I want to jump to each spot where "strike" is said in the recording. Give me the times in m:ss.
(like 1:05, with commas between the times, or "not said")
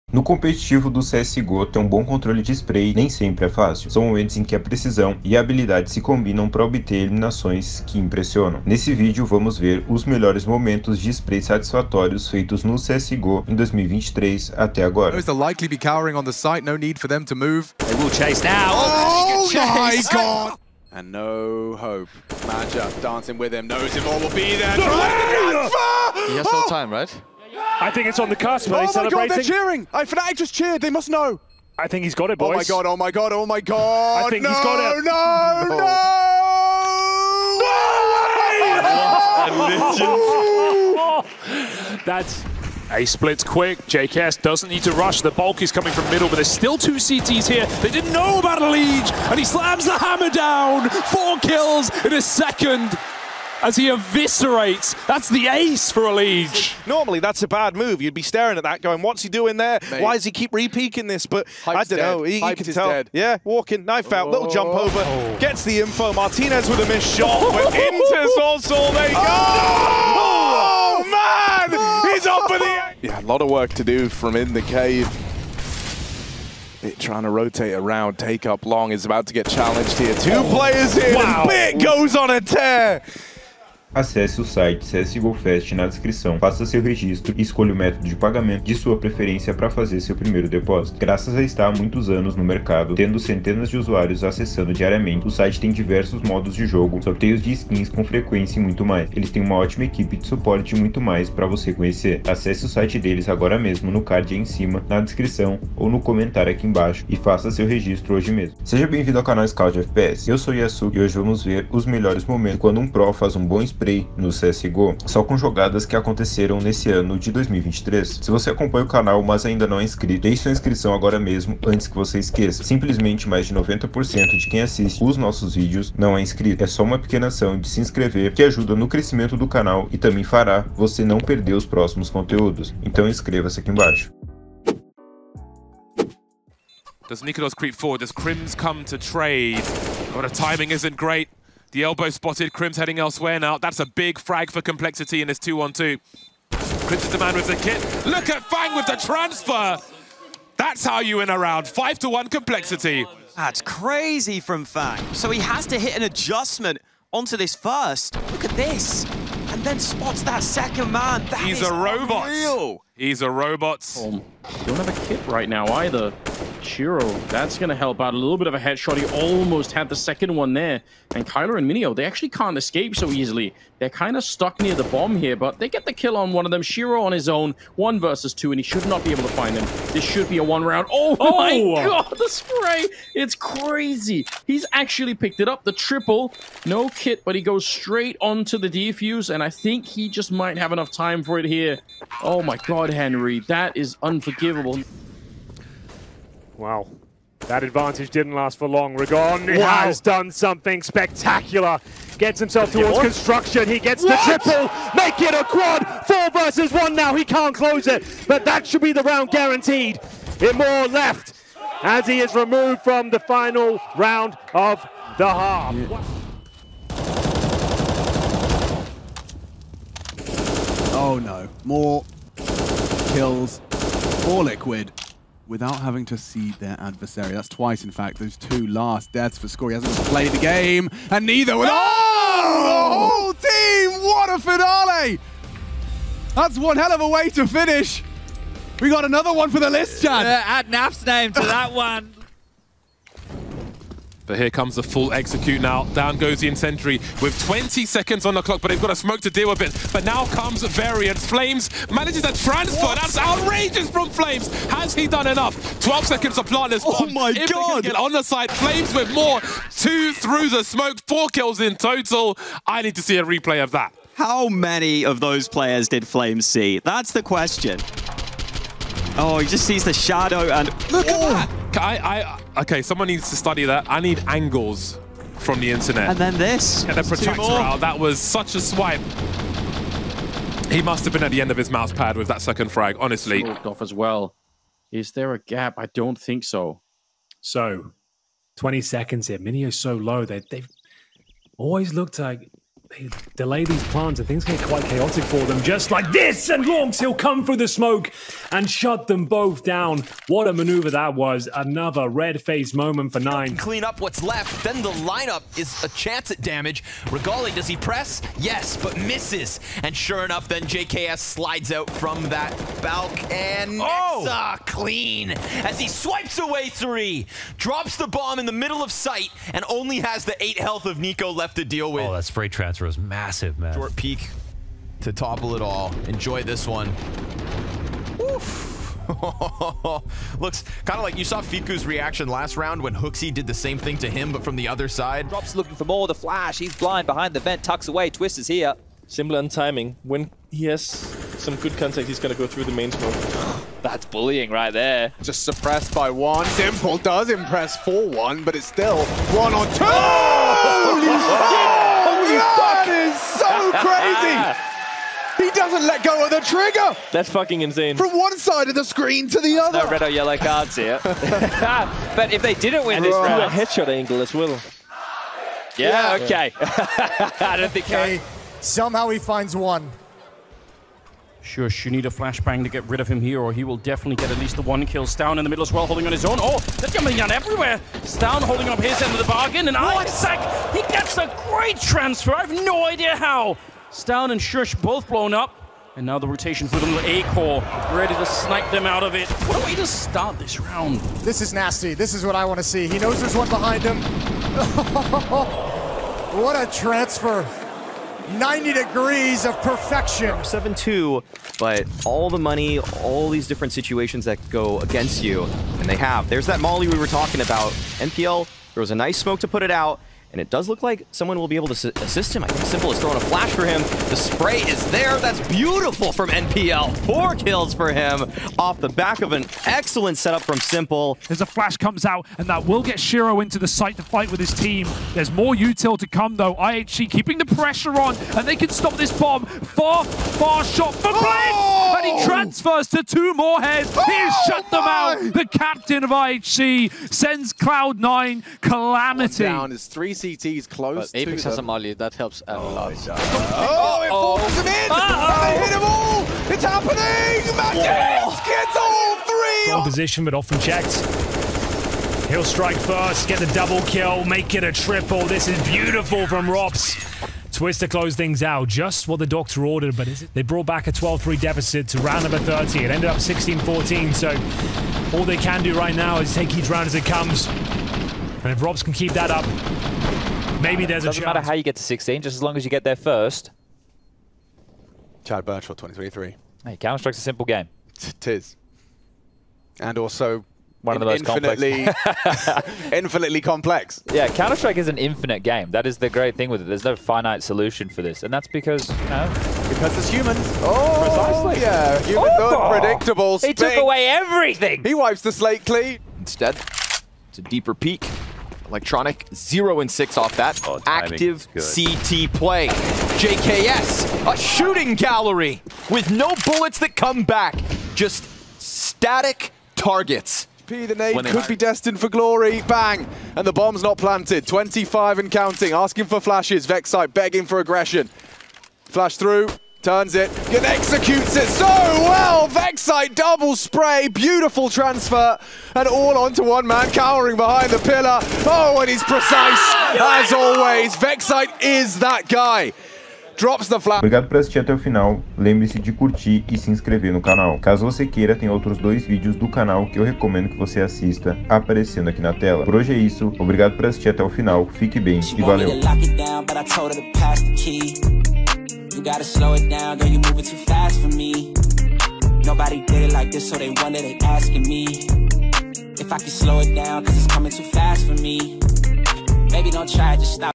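7:32, 7:56, 8:04.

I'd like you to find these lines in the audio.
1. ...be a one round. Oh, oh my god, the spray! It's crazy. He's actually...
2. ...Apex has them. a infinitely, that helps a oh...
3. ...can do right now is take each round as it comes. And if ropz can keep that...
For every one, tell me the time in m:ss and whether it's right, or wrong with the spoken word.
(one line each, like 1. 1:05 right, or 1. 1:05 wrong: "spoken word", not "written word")
1. 3:00 right
2. 7:21 wrong: "molly", not "infinitely"
3. 7:45 right.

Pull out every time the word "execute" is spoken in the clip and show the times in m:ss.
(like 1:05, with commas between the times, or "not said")
4:05, 8:40.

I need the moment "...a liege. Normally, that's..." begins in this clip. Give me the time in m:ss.
0:56.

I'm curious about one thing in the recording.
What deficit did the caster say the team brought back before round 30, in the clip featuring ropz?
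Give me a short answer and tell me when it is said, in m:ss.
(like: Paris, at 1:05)
12-3, at 7:40.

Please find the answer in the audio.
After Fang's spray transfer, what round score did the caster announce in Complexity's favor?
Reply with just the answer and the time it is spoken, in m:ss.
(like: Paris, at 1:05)
5 to 1, at 2:31.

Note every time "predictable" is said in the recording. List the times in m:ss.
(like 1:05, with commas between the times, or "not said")
8:12.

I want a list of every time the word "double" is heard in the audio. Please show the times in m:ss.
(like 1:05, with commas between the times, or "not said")
7:33, 8:43.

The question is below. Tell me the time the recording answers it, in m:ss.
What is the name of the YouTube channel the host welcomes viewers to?
1:49.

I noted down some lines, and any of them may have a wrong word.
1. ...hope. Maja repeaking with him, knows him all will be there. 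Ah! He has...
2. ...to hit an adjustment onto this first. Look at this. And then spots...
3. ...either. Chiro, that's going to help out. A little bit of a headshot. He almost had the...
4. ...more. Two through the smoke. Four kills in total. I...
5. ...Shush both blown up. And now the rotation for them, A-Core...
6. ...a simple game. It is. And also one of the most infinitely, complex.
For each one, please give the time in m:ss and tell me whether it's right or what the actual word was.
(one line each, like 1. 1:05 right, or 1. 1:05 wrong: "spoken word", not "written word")
1. 0:21 wrong: "dancing", not "repeaking"
2. 2:35 right
3. 2:45 right
4. 4:19 right
5. 6:24 right
6. 7:57 right.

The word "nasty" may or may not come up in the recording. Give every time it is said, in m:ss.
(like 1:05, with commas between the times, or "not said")
6:31.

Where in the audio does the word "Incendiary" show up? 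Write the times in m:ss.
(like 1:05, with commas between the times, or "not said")
4:06.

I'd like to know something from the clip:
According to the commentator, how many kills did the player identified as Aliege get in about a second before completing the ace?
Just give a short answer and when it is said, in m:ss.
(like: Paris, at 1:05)
4, at 0:50.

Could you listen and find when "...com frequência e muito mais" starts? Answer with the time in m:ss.
1:37.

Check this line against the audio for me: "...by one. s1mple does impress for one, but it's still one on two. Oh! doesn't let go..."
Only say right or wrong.
right.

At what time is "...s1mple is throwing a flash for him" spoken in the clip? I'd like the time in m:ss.
6:52.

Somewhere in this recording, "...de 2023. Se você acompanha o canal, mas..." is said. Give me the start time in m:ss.
1:57.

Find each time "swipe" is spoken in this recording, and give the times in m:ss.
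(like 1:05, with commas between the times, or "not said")
4:38, 5:15.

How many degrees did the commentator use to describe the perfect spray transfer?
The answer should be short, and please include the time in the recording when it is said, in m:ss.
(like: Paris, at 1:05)
90, at 6:38.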